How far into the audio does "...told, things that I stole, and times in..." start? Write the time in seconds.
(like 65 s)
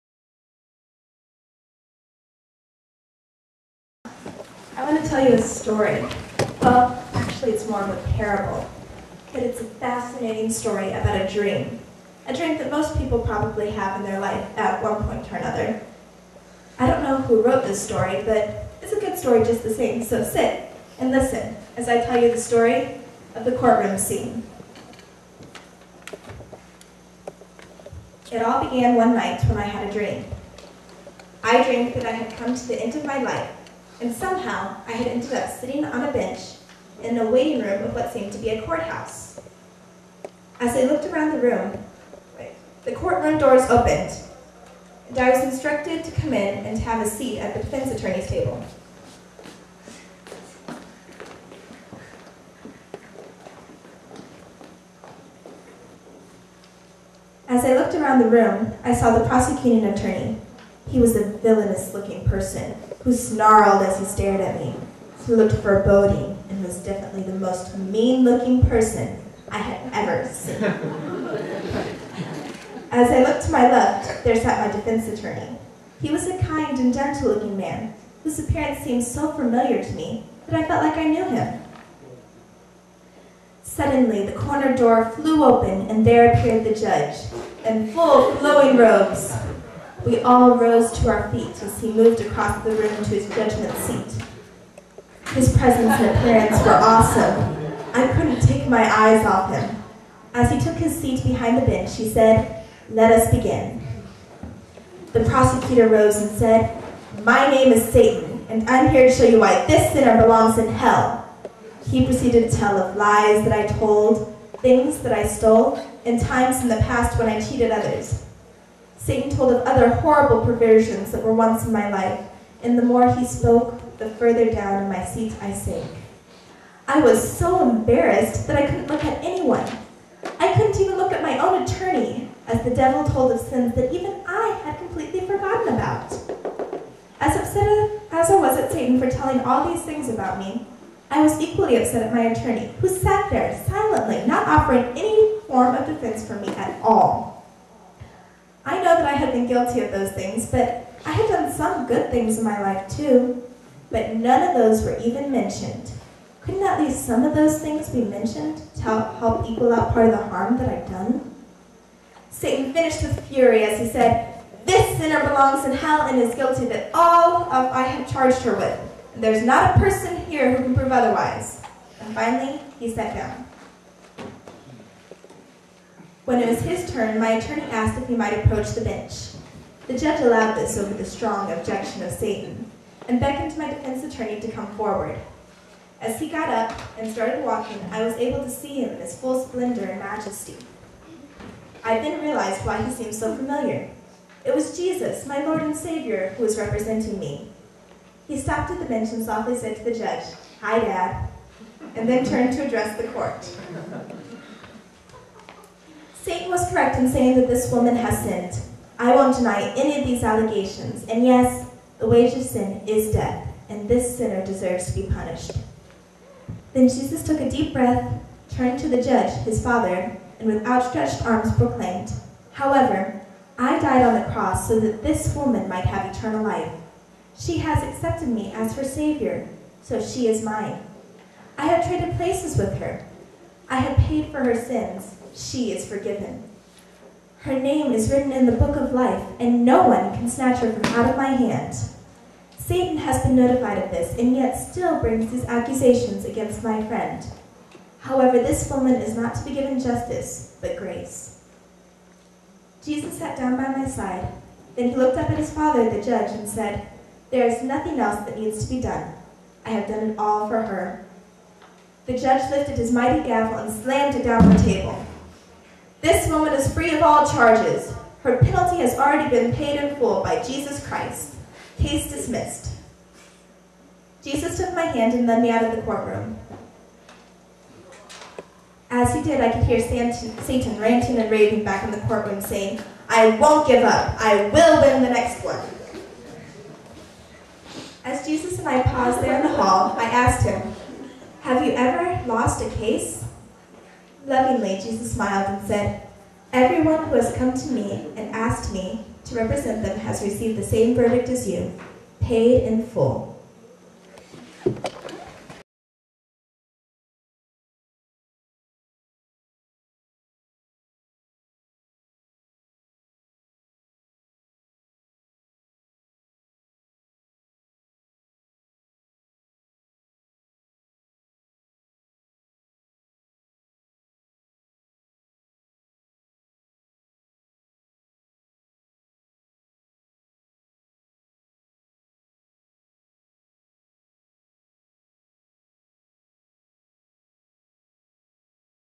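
113 s.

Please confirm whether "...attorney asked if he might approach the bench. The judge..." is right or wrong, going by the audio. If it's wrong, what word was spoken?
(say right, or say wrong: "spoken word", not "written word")
right.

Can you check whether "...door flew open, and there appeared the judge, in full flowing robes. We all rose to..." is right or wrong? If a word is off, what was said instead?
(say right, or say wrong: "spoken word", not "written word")
right.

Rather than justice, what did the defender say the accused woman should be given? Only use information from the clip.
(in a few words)
Grace.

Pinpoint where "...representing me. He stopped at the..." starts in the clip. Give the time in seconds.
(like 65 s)
196 s.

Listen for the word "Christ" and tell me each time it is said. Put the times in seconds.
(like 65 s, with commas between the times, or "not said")
270 s.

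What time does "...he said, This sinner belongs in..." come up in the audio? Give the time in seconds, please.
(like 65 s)
163 s.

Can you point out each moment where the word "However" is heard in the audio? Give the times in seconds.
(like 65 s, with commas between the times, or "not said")
222 s, 248 s.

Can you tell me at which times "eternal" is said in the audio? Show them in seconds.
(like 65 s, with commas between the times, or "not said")
226 s.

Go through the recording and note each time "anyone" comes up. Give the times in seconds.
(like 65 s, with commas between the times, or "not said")
129 s.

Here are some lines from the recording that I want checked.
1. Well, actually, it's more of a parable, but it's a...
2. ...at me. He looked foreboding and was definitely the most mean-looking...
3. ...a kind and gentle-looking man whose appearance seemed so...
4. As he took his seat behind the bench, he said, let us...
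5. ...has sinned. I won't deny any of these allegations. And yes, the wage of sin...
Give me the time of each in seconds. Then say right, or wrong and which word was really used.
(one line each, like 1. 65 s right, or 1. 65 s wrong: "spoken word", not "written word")
1. 6 s right
2. 64 s right
3. 76 s right
4. 100 s right
5. 207 s right.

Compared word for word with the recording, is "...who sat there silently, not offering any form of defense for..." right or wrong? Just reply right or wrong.
right.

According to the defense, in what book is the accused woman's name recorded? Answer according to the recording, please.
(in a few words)
The book of life.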